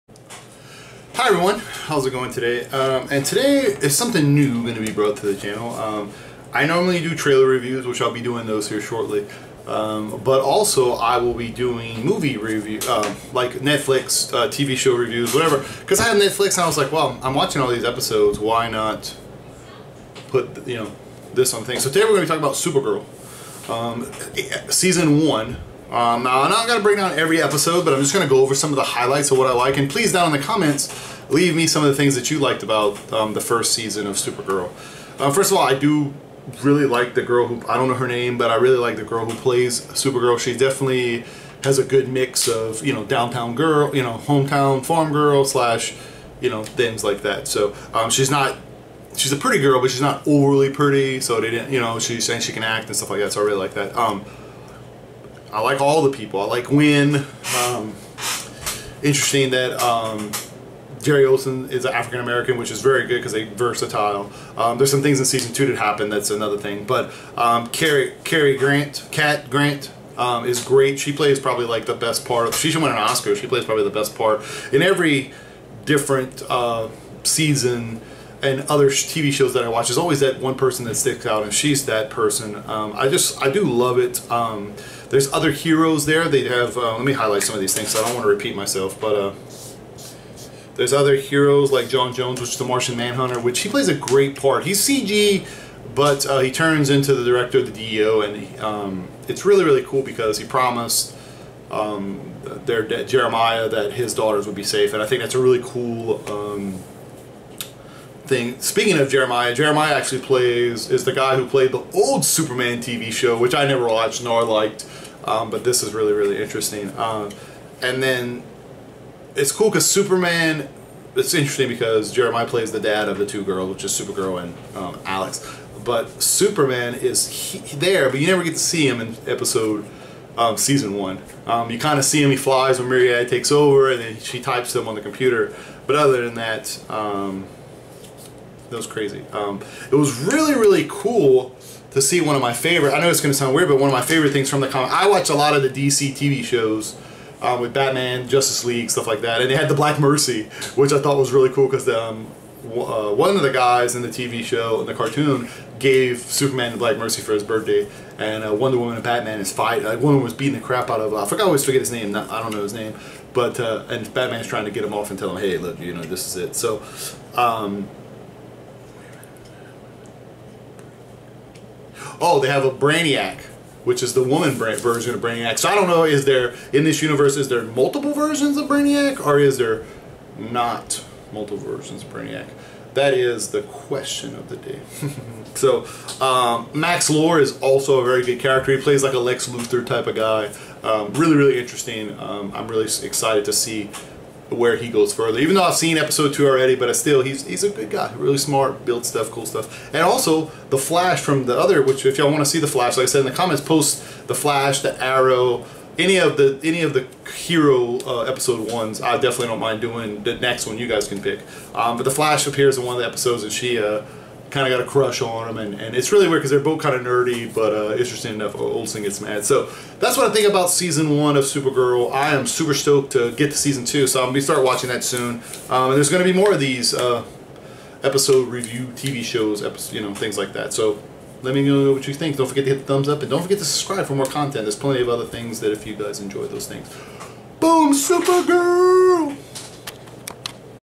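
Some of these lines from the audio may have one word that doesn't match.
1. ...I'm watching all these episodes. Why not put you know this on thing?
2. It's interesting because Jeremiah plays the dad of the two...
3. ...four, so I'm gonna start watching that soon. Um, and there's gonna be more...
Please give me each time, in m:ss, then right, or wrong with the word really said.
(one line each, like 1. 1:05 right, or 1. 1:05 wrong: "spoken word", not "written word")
1. 0:17 right
2. 2:01 right
3. 3:43 wrong: "two", not "four".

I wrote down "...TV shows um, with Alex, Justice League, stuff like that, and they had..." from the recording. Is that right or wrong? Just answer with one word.
wrong.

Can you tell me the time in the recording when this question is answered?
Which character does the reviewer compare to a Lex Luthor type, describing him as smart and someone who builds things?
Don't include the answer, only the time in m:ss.
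3:06.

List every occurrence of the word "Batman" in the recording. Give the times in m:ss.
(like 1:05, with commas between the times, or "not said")
2:27, 2:39, 2:44.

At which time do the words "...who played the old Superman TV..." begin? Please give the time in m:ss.
1:51.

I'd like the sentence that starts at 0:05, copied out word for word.
Um, I normally do trailer reviews, which I'll be doing those here shortly.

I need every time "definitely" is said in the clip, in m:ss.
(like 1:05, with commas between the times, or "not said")
0:40, 3:29.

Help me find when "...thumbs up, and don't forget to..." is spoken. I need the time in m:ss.
3:52.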